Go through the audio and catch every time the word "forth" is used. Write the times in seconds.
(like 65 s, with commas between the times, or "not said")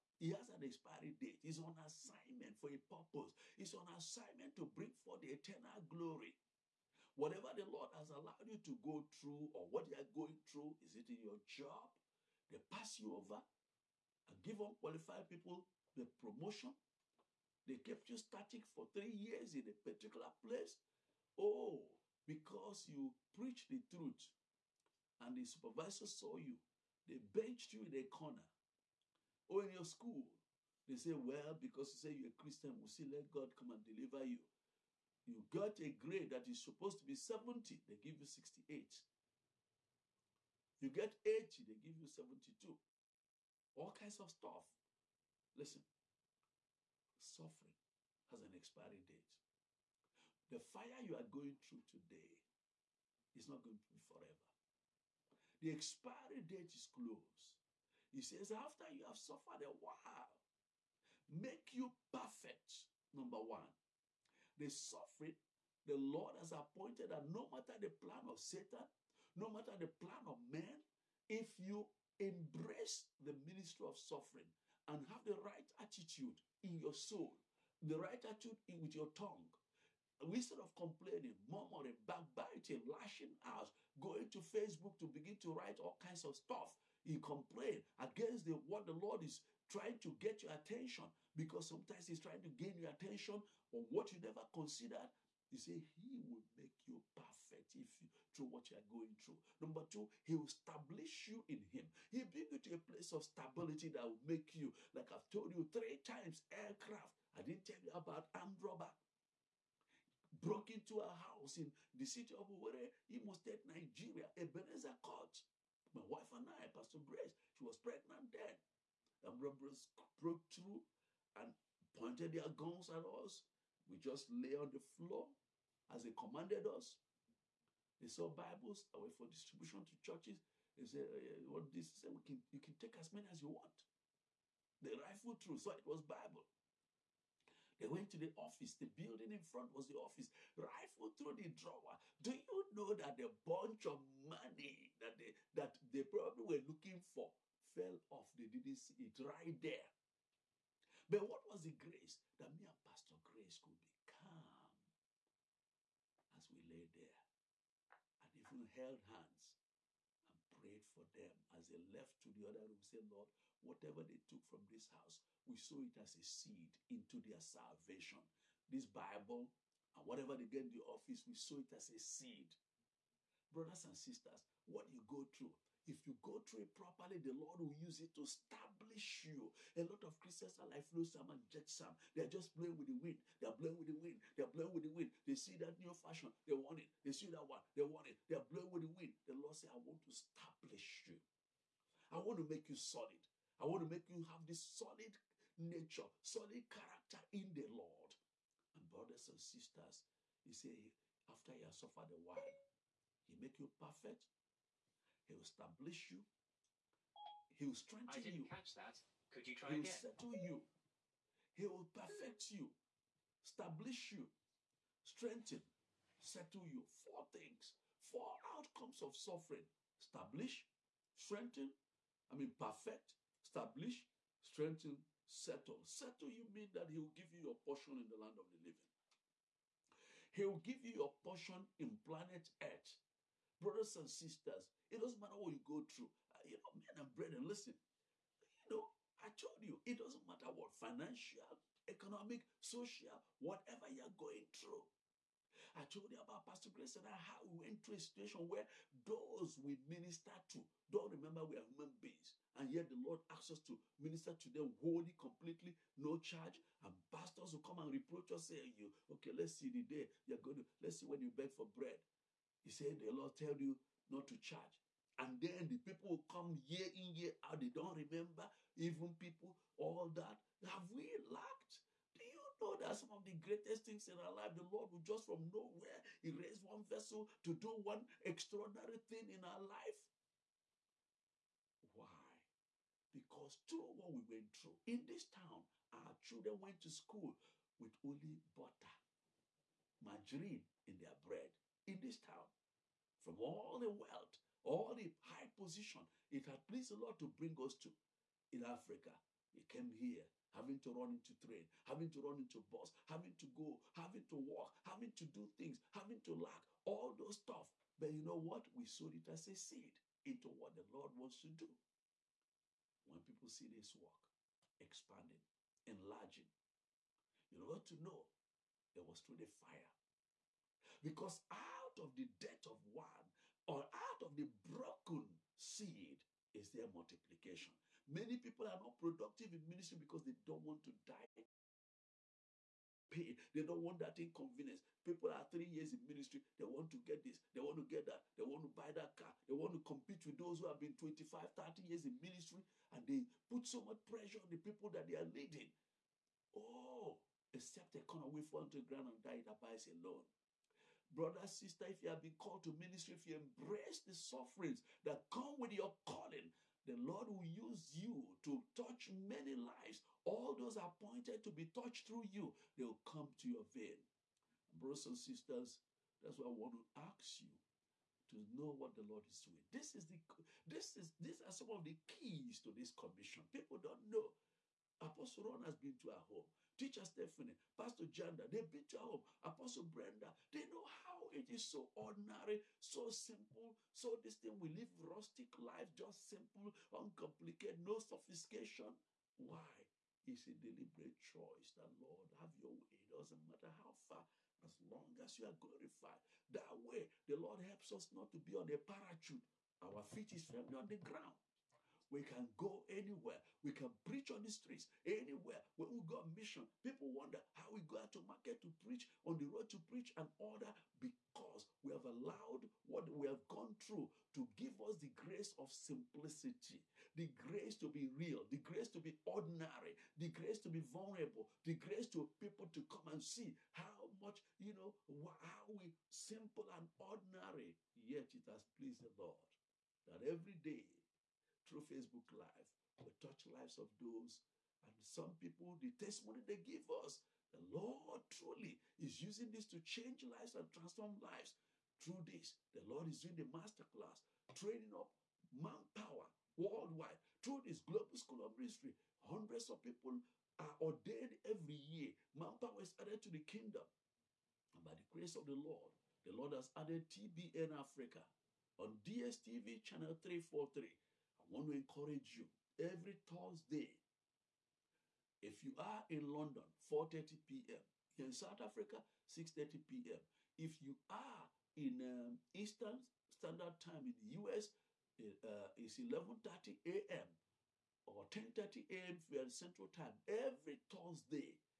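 4 s.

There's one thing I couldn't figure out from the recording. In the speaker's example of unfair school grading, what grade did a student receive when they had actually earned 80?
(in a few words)
72.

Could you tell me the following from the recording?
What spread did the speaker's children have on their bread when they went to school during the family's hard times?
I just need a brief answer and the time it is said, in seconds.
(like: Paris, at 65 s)
margarine, at 289 s.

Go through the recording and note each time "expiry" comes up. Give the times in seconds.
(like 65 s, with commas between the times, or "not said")
0 s, 48 s, 55 s.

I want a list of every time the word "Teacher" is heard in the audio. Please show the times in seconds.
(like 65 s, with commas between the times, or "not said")
376 s.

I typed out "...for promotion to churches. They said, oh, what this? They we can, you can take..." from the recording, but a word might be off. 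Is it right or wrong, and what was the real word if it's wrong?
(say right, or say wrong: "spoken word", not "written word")
wrong: "distribution", not "promotion".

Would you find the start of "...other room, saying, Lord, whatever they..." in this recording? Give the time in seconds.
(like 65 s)
162 s.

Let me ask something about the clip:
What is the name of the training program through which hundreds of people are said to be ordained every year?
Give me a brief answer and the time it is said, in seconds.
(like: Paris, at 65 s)
Global School of Ministry, at 447 s.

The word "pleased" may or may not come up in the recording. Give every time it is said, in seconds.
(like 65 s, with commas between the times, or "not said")
296 s, 428 s.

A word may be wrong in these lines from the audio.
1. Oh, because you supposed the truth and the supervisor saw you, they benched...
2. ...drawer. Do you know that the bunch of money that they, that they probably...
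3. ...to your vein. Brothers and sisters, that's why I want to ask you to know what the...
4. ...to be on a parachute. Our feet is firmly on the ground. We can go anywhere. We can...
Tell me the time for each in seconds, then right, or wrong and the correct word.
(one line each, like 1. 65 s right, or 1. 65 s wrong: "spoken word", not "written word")
1. 21 s wrong: "preached", not "supposed"
2. 141 s right
3. 363 s right
4. 398 s right.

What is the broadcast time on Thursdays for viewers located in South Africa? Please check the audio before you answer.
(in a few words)
6:30 p.m.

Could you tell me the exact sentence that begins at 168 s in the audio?
This Bible and whatever they get in the office, we sow it as a seed.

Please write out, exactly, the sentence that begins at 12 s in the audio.
They pass you over and give unqualified people the promotion.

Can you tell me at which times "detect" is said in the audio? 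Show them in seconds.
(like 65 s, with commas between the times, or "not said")
not said.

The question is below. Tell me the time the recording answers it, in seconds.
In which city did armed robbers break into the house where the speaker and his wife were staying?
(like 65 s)
112 s.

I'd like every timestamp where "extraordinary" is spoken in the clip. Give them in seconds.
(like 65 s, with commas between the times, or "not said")
278 s.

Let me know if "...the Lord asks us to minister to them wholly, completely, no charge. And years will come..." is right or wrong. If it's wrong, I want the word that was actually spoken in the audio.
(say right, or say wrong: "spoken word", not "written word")
wrong: "pastors", not "years".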